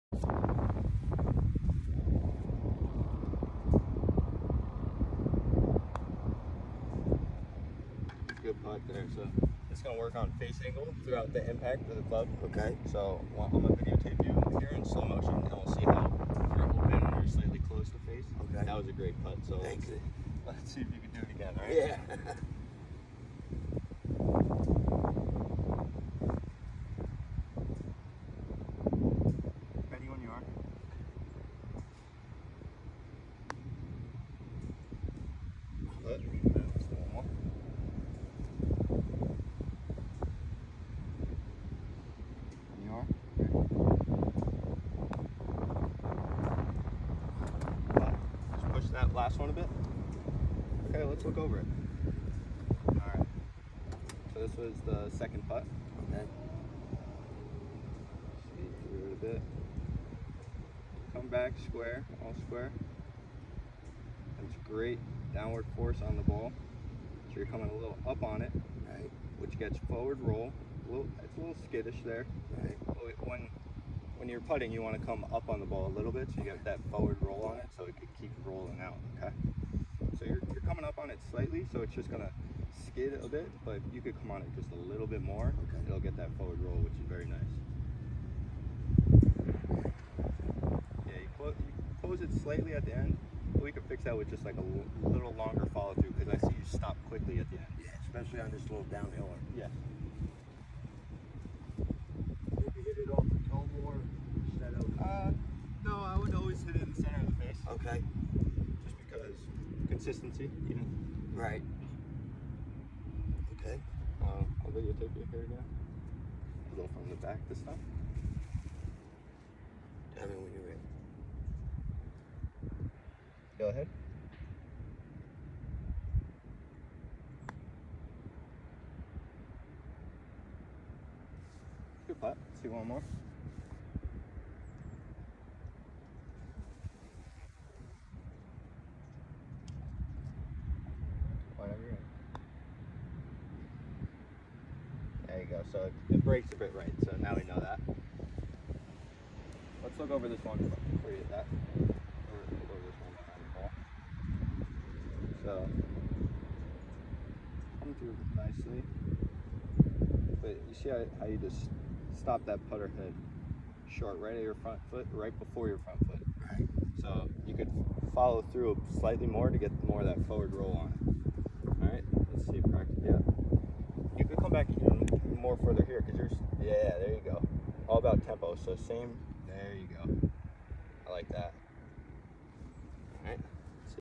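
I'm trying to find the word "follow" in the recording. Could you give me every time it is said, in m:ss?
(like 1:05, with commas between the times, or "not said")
1:35, 2:48.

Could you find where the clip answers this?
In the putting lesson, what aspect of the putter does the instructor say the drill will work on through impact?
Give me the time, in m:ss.
0:10.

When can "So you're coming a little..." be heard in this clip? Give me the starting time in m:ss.
1:07.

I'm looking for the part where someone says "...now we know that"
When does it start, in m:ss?
2:27.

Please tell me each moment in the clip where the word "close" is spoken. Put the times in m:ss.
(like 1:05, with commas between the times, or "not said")
0:17, 1:32.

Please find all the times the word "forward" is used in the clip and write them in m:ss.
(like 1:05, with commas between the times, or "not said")
1:09, 1:16, 1:26, 2:50.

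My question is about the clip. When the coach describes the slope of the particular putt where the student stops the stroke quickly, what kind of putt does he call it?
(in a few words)
Downhiller.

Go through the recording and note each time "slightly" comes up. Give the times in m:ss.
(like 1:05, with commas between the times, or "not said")
0:17, 1:21, 1:32, 2:48.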